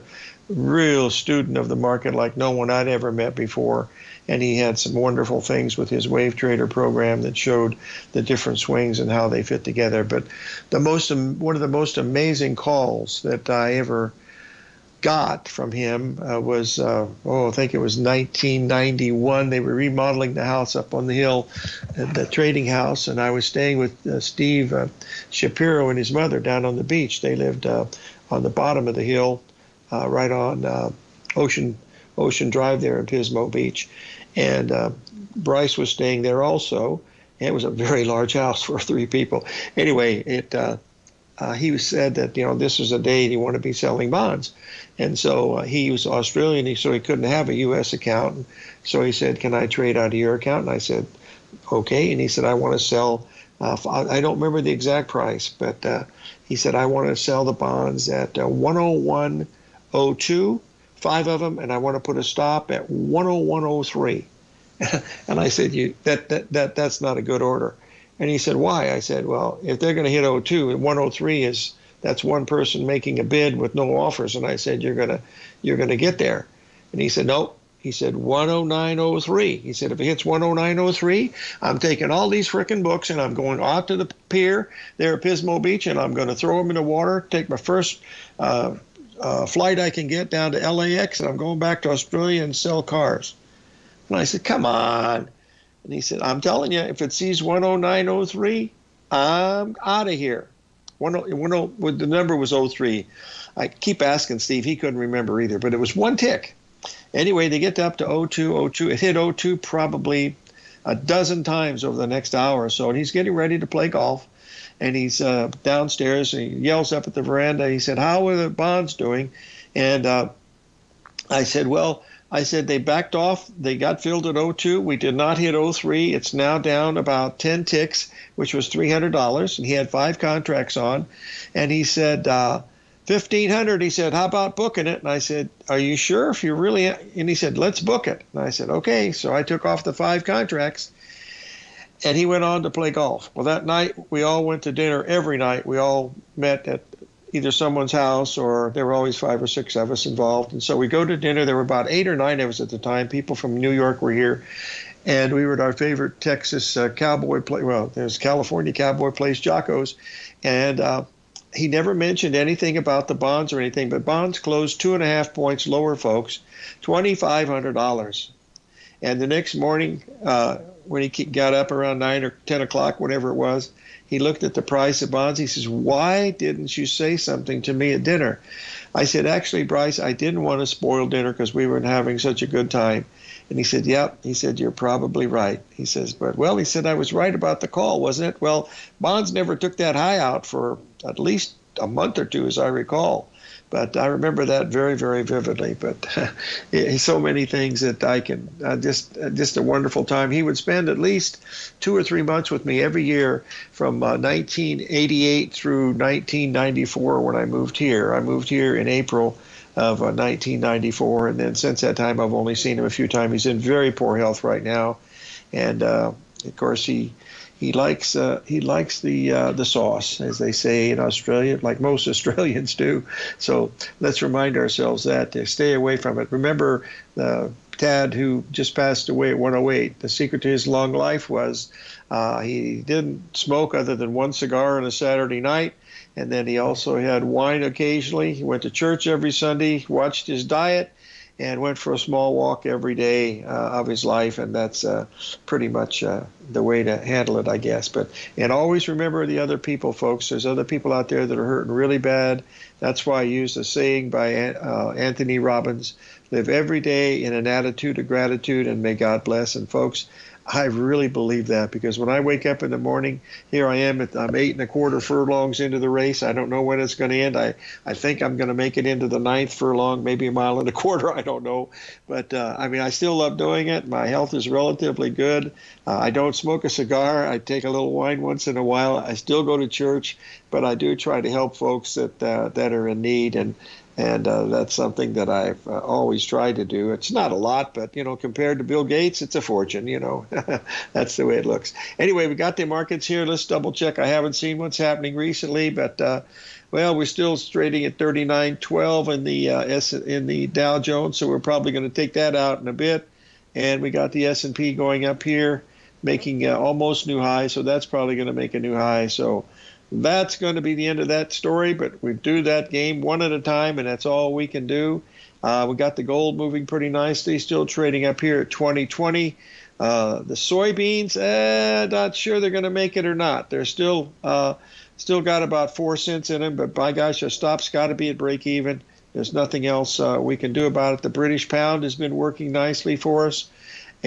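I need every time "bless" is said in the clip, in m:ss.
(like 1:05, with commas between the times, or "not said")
4:19.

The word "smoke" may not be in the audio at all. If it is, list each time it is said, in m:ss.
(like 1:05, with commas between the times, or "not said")
3:53, 4:36.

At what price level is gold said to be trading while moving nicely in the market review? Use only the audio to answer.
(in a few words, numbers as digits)
2020.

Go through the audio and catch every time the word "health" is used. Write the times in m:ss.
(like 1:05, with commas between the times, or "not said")
3:34, 4:34.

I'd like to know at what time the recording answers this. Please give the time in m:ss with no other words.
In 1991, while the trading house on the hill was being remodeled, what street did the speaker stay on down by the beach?
0:31.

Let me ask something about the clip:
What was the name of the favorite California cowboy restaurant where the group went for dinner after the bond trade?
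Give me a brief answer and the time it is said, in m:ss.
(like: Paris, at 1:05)
Jocko's, at 2:39.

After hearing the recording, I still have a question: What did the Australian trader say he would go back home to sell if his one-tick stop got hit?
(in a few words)
Cars.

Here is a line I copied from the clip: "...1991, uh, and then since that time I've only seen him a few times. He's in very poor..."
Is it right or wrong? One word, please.
wrong.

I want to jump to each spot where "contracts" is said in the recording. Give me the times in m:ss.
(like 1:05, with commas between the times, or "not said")
2:10, 2:20.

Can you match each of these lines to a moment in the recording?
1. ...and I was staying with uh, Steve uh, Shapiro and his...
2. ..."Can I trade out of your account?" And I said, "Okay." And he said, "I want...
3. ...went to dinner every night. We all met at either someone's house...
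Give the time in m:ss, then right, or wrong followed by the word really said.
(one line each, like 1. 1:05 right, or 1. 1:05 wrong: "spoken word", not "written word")
1. 0:23 right
2. 0:49 right
3. 2:24 right.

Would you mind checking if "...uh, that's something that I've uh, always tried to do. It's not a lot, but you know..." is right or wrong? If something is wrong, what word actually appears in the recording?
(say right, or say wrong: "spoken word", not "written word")
right.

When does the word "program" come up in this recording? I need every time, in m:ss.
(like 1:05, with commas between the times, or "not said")
0:06.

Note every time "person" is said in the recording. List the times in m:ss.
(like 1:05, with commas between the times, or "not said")
1:12.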